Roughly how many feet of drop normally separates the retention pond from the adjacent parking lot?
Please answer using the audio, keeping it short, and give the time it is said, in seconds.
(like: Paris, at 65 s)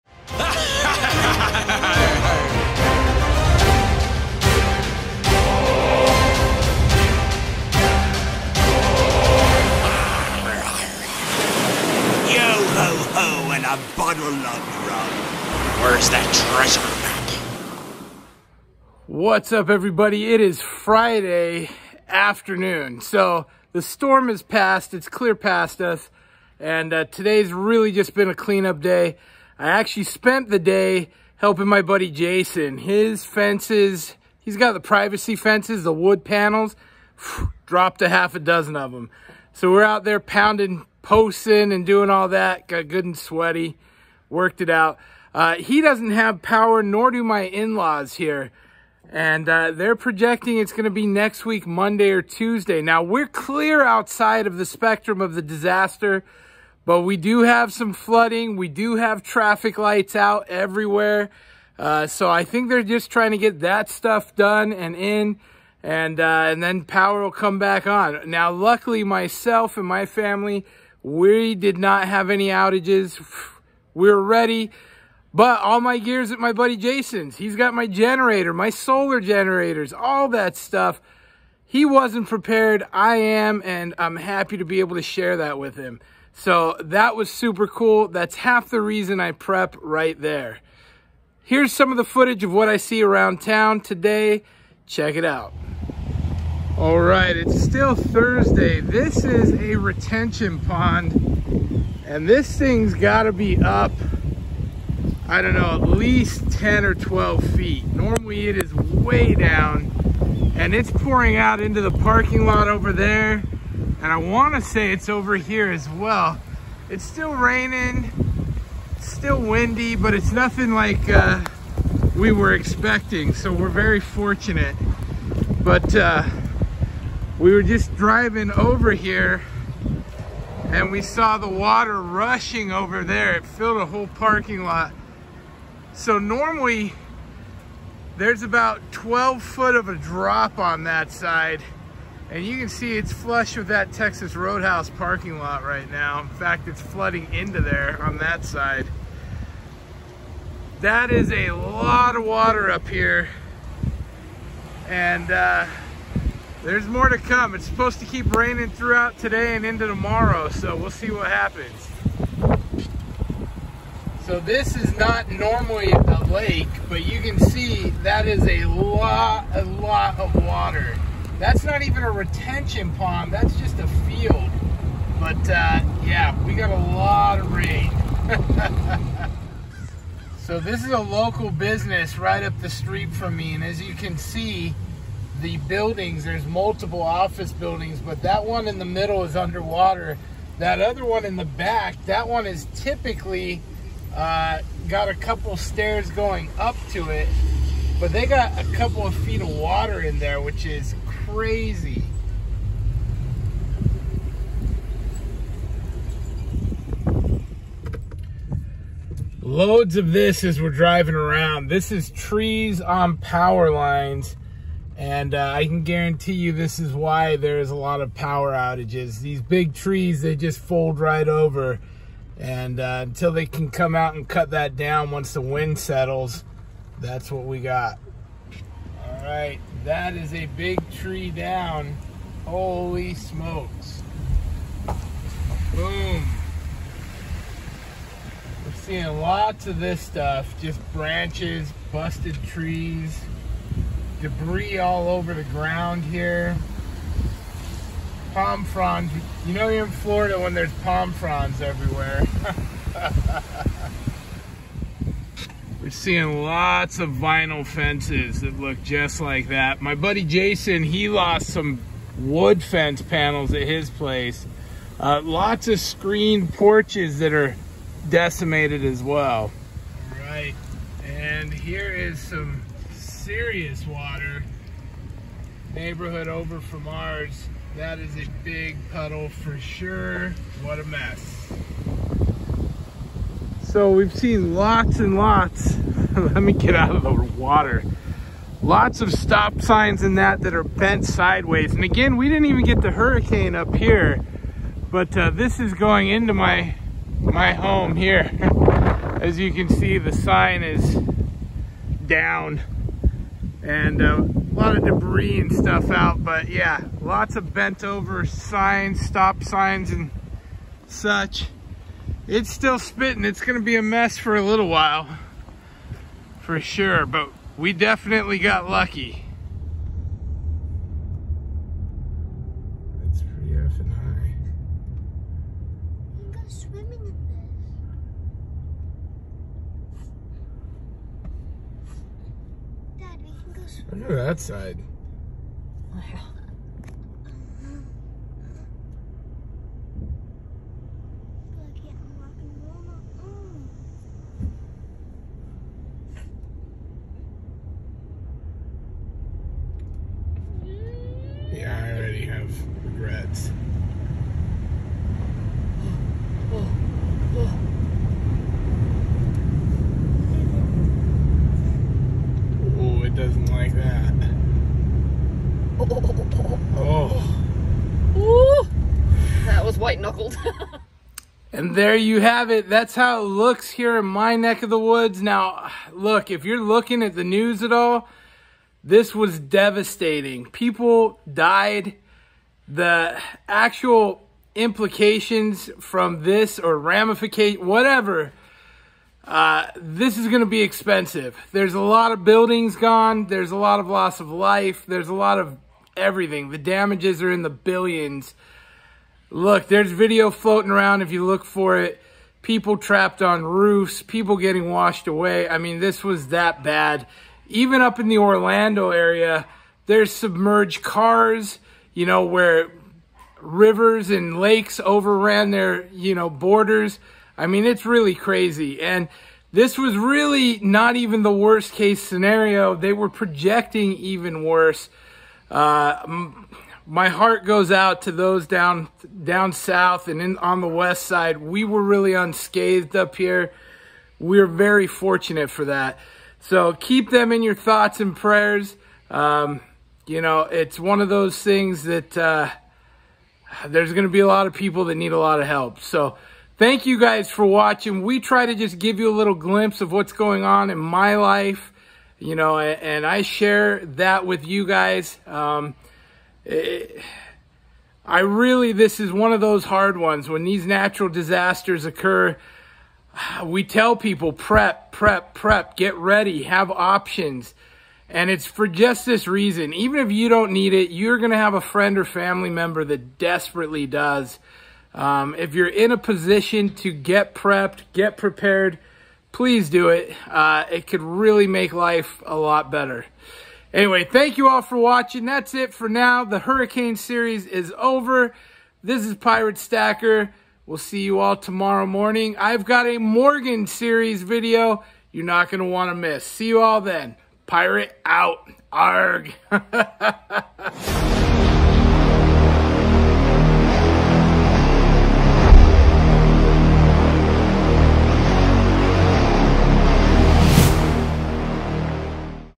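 12 foot, at 138 s.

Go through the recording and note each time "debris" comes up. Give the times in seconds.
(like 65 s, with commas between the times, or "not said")
244 s, 304 s.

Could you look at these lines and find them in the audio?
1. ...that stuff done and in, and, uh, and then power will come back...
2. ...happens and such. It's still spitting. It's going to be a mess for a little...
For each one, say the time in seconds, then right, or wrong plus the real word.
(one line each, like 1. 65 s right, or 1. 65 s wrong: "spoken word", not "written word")
1. 63 s right
2. 309 s wrong: "signs", not "happens".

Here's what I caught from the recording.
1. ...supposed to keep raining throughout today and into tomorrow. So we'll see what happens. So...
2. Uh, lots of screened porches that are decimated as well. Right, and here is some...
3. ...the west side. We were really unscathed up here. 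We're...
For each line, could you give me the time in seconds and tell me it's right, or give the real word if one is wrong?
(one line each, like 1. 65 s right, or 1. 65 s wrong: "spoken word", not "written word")
1. 157 s right
2. 264 s right
3. 430 s right.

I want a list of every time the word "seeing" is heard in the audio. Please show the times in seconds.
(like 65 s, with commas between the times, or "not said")
238 s, 255 s.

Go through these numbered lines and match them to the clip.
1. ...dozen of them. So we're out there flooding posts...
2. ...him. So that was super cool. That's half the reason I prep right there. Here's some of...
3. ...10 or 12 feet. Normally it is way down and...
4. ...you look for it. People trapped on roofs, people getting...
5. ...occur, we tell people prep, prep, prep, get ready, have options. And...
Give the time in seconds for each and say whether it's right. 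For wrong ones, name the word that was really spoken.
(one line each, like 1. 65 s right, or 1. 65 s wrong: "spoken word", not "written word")
1. 38 s wrong: "pounding", not "flooding"
2. 85 s right
3. 106 s right
4. 401 s right
5. 461 s right.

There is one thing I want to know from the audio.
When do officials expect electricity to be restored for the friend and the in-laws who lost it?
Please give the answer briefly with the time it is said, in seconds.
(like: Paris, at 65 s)
Monday or Tuesday, at 51 s.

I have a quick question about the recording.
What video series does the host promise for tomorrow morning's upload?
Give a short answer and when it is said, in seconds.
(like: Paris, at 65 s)
Morgan series, at 492 s.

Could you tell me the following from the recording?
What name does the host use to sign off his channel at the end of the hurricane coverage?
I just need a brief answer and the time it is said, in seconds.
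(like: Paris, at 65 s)
Pirate Stacker, at 489 s.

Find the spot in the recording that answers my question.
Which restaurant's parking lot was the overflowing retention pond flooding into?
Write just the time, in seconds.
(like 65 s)
143 s.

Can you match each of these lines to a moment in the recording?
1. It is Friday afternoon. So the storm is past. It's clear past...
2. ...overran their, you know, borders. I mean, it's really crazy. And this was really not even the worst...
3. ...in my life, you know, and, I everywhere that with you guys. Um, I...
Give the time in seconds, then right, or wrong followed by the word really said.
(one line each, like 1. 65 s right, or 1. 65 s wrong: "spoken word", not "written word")
1. 20 s right
2. 414 s right
3. 450 s wrong: "share", not "everywhere".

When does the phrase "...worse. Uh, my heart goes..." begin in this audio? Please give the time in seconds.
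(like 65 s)
424 s.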